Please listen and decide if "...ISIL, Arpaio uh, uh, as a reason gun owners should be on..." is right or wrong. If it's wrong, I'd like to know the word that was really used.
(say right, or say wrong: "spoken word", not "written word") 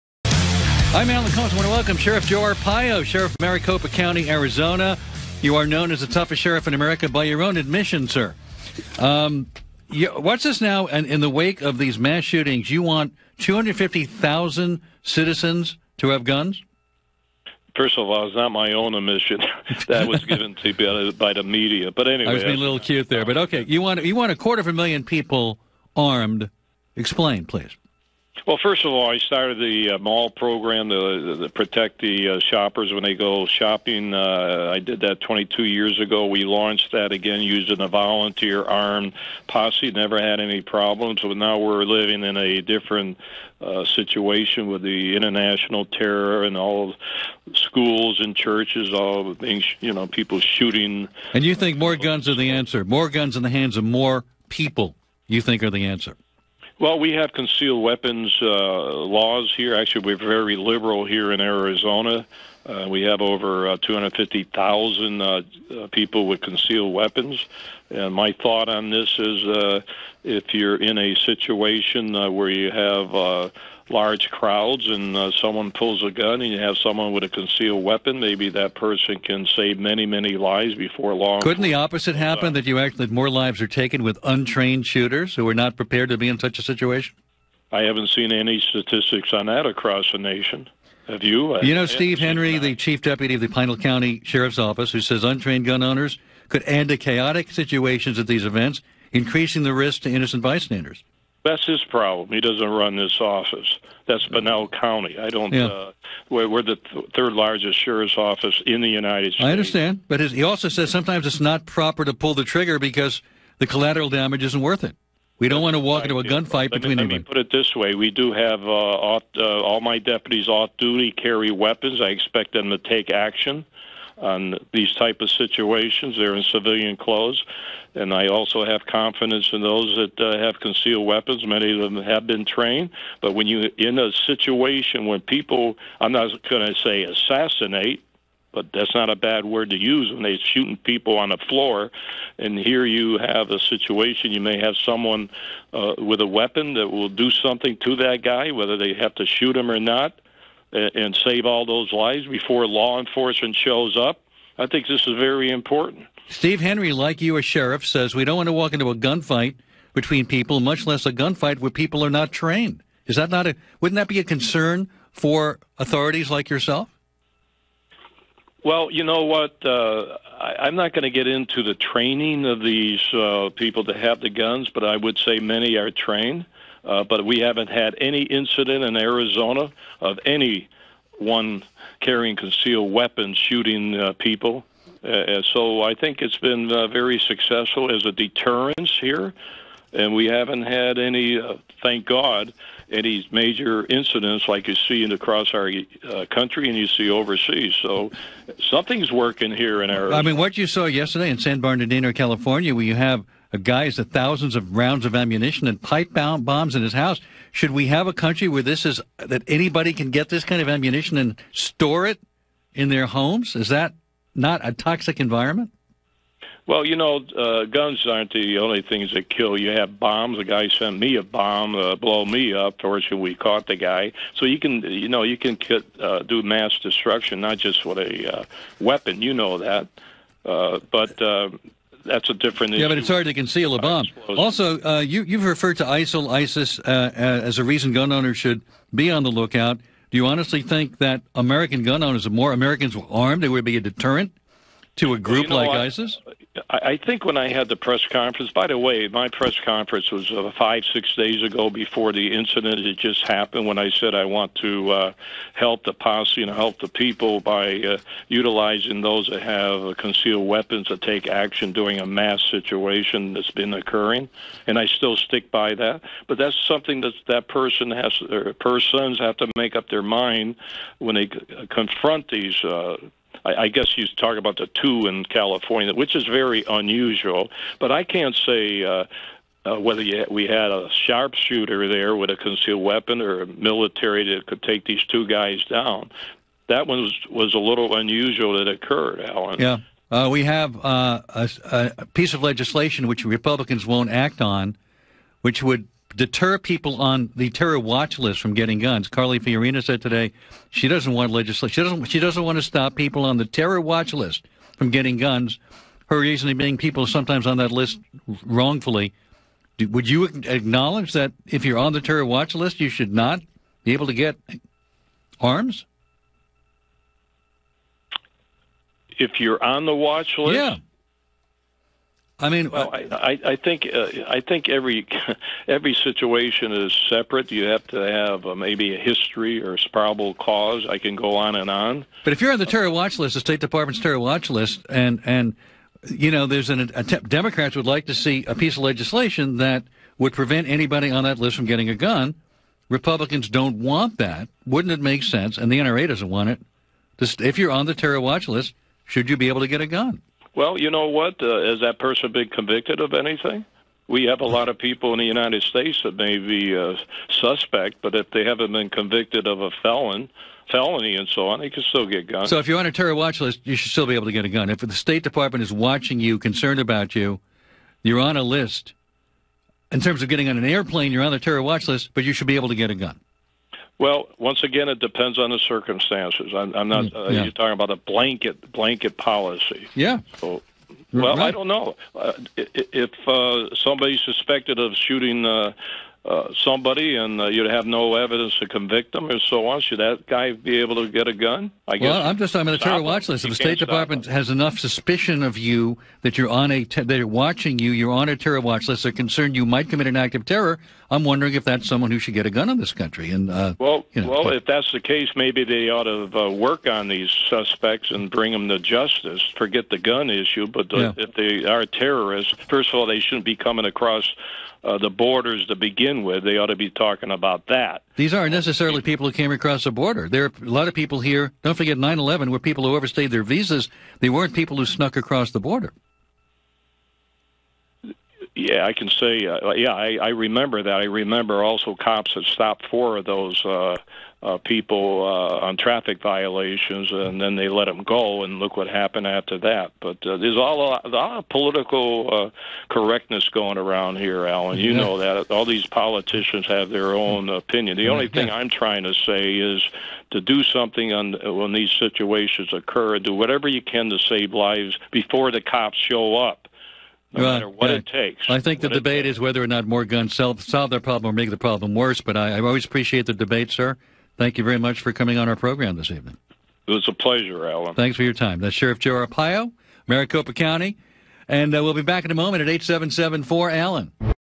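wrong: "ISIS", not "Arpaio".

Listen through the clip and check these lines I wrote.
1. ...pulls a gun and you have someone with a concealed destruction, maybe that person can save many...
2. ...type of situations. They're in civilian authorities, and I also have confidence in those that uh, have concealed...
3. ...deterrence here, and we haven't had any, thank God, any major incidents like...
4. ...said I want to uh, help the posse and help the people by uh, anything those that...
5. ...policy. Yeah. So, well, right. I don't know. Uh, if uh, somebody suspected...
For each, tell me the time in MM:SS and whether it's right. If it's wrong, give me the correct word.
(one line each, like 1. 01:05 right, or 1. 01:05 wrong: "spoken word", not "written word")
1. 01:15 wrong: "weapon", not "destruction"
2. 02:04 wrong: "clothes", not "authorities"
3. 03:08 right
4. 04:13 wrong: "utilizing", not "anything"
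5. 06:19 right.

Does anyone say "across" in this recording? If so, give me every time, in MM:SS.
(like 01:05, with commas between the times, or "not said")
01:29, 03:15, 06:53, 06:59, 07:05.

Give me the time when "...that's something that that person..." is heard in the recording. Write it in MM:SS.
04:26.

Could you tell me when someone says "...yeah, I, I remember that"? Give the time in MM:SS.
07:09.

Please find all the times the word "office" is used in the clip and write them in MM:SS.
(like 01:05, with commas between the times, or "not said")
01:34, 01:43, 01:48.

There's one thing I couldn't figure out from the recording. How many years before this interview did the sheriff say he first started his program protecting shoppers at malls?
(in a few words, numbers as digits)
22 years.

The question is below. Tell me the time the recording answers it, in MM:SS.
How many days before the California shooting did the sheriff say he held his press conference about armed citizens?
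04:10.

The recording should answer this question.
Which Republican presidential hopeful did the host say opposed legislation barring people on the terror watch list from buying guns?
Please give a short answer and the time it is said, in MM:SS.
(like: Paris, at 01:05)
Carly Fiorina, at 04:59.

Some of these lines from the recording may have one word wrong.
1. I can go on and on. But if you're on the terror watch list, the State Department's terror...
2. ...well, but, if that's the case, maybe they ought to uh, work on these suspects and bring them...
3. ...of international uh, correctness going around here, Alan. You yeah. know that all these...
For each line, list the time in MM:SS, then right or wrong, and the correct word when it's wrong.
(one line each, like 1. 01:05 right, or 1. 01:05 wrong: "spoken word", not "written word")
1. 05:30 right
2. 06:44 right
3. 07:21 wrong: "political", not "international".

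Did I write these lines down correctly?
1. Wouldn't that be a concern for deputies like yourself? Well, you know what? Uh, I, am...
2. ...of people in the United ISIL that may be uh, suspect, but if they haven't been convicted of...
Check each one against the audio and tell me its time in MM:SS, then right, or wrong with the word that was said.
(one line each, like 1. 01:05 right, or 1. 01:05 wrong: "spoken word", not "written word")
1. 02:43 wrong: "authorities", not "deputies"
2. 05:54 wrong: "States", not "ISIL".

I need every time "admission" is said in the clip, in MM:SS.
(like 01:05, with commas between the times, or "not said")
00:07, 00:18.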